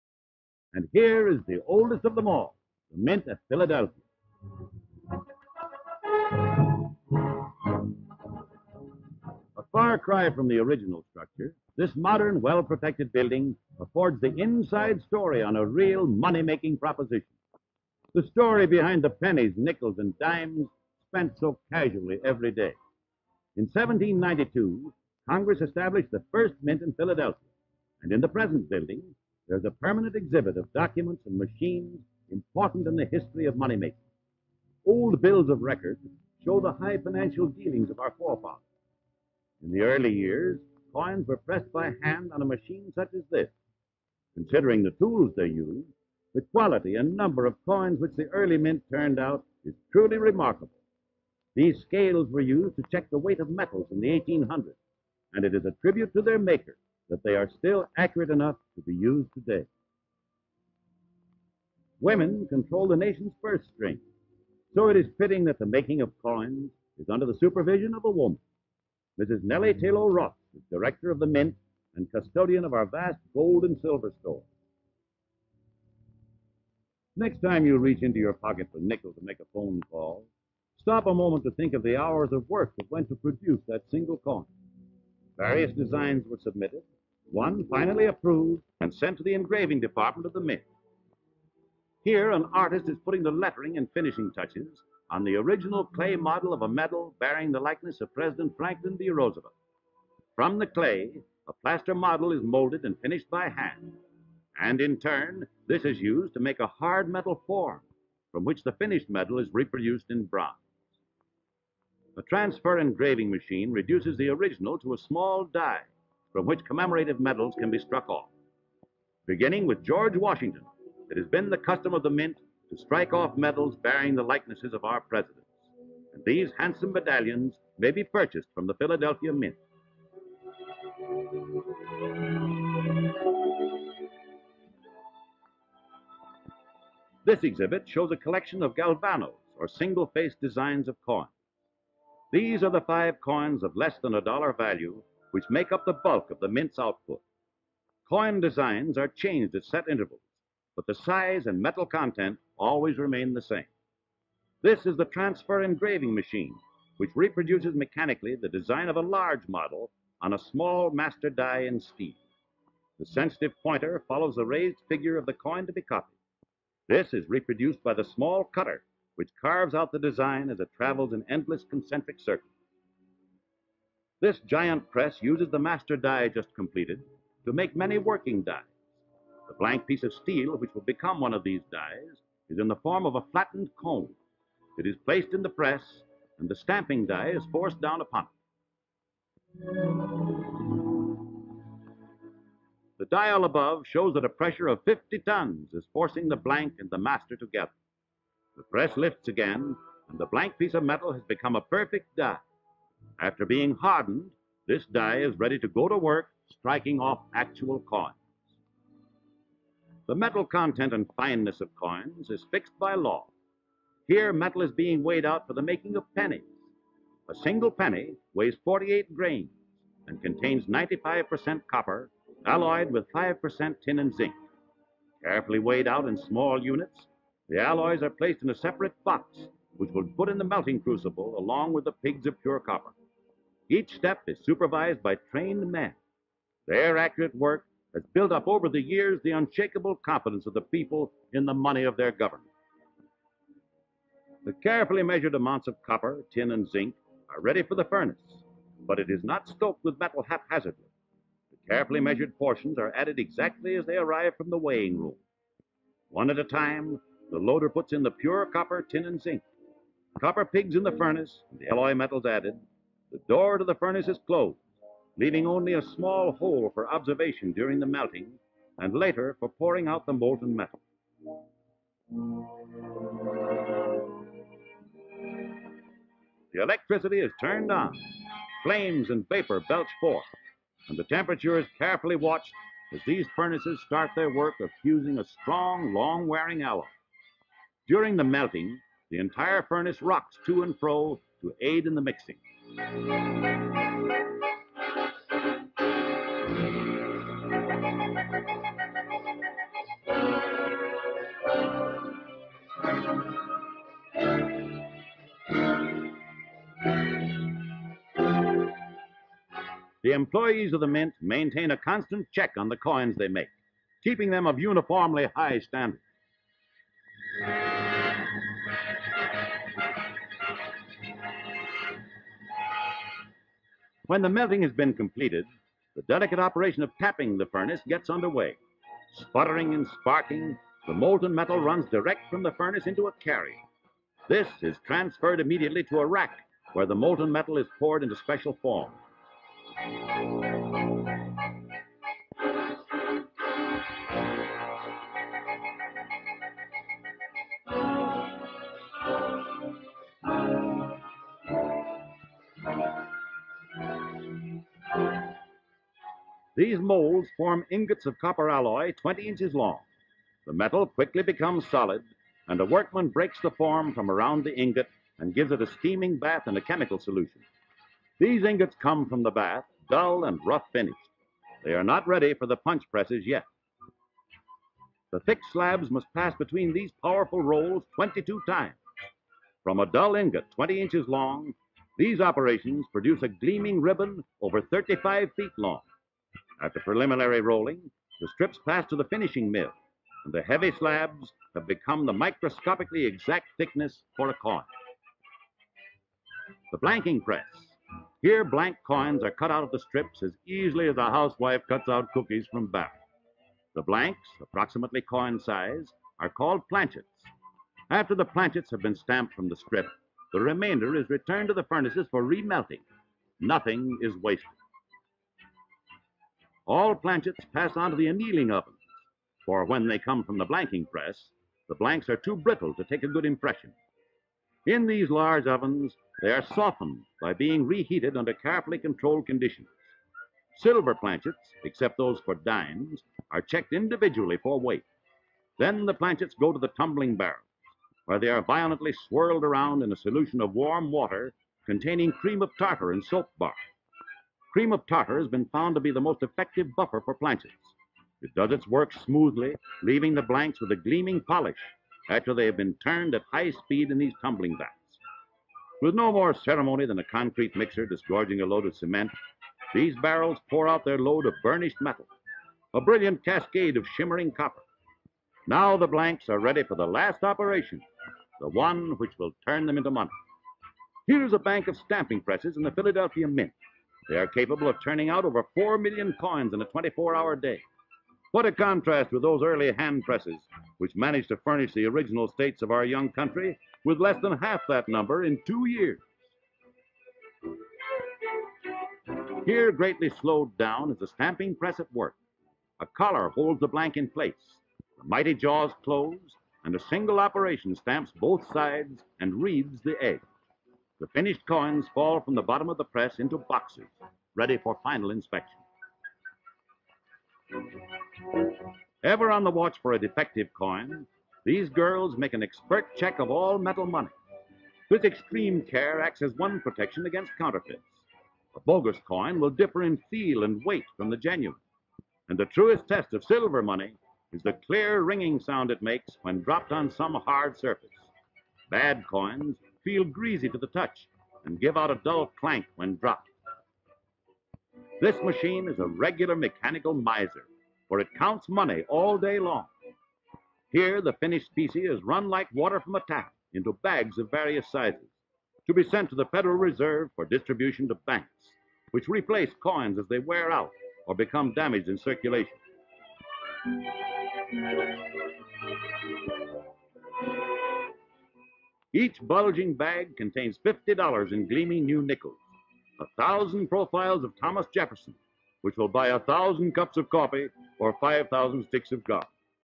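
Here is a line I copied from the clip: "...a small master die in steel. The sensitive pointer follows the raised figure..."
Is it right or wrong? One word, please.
right.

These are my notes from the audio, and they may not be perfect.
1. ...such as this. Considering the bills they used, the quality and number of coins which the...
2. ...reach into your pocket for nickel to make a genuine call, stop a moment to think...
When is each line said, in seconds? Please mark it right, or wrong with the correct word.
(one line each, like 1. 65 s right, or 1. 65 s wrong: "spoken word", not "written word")
1. 42 s wrong: "tools", not "bills"
2. 77 s wrong: "phone", not "genuine".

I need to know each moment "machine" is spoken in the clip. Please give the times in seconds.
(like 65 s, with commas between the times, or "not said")
31 s, 42 s, 113 s, 156 s, 535 s.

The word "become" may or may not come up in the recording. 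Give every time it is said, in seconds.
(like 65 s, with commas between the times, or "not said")
180 s, 201 s, 361 s, 391 s, 551 s.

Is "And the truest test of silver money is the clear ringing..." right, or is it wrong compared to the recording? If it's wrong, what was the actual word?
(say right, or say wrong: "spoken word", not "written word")
right.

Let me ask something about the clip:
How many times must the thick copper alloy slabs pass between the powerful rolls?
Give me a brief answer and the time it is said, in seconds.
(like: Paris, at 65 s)
22, at 377 s.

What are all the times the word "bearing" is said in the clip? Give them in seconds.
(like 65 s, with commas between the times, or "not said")
97 s, 123 s.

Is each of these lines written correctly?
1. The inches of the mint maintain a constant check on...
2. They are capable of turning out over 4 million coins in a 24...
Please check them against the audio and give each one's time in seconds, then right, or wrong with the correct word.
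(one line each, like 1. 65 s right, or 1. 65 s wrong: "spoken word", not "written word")
1. 310 s wrong: "employees", not "inches"
2. 474 s right.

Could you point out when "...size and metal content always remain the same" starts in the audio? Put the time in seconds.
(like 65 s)
150 s.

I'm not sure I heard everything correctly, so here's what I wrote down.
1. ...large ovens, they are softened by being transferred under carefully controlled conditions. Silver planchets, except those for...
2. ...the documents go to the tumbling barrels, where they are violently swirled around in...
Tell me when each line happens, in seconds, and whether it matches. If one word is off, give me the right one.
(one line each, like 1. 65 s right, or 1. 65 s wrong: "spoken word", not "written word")
1. 425 s wrong: "reheated", not "transferred"
2. 435 s wrong: "planchets", not "documents".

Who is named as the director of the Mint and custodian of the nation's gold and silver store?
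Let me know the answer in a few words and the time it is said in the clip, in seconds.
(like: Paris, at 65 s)
Nellie Taylor Ross, at 69 s.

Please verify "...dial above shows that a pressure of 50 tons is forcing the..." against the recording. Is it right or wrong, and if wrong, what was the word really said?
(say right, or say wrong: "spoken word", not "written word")
right.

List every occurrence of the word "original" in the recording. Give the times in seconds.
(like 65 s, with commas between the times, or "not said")
10 s, 95 s, 114 s, 481 s.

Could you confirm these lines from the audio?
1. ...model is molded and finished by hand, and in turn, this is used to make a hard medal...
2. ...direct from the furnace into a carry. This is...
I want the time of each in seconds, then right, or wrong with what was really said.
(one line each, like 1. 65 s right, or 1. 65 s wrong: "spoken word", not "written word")
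1. 101 s right
2. 331 s right.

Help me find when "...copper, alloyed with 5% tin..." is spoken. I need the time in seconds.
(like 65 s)
221 s.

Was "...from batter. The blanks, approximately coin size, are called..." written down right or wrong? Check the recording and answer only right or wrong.
right.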